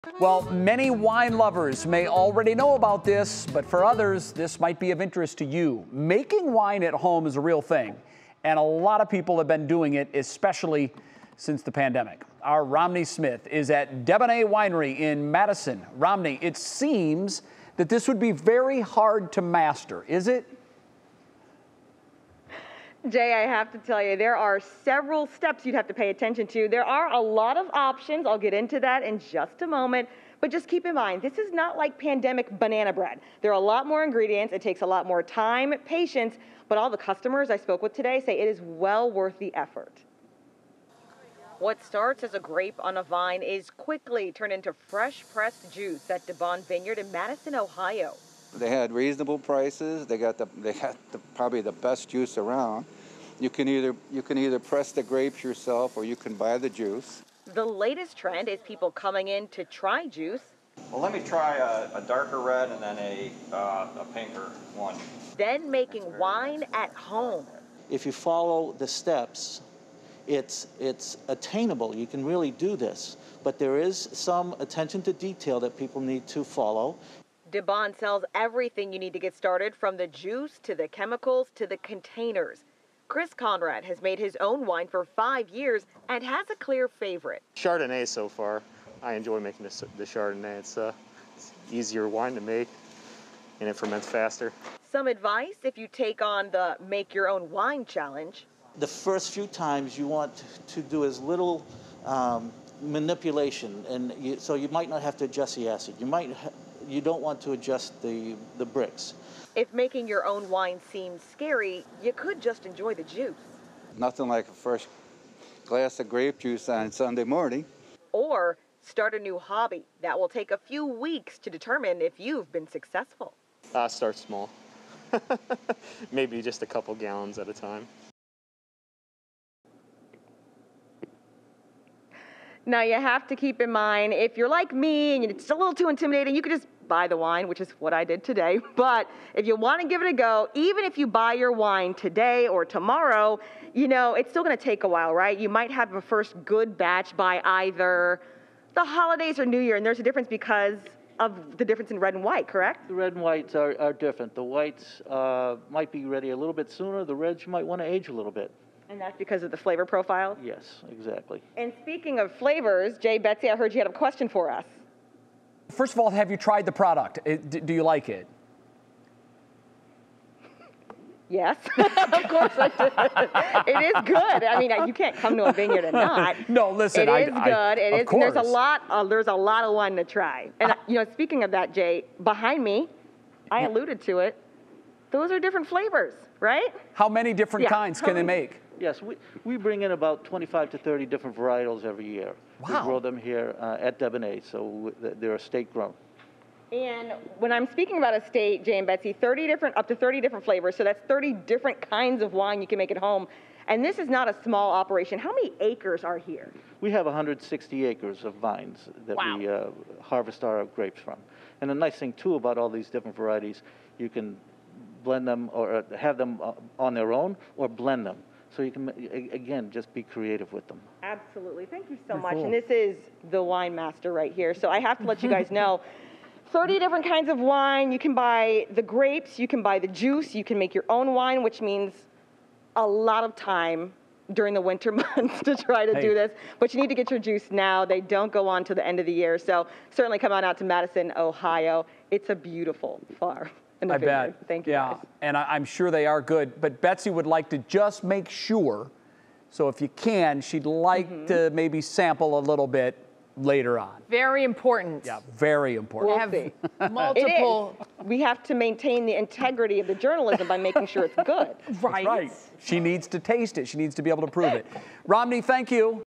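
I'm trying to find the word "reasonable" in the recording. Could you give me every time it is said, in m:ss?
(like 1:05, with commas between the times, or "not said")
0:48.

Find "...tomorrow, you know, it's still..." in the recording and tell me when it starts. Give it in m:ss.
2:22.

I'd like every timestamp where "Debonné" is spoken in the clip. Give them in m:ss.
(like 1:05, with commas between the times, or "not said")
0:14, 0:46, 1:17, 3:13.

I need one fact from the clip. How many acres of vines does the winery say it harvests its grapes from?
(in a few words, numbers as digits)
160.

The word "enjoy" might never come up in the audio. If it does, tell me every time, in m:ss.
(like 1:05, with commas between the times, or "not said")
1:29, 1:52.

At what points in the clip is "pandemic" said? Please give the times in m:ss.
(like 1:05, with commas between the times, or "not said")
0:11, 0:31.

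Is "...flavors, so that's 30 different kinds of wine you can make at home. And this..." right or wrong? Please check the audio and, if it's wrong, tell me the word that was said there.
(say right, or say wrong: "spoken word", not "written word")
right.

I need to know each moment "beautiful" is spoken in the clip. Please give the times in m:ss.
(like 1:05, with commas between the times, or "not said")
4:02.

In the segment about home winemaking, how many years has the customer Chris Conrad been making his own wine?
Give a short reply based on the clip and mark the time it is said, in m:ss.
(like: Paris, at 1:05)
5, at 1:25.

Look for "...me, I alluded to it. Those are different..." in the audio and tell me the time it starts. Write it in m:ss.
3:02.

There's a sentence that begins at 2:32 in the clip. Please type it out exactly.
The red and whites are, are different.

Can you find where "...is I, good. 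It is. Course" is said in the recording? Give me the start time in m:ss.
2:57.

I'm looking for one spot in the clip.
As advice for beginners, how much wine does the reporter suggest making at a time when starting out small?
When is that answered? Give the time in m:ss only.
2:06.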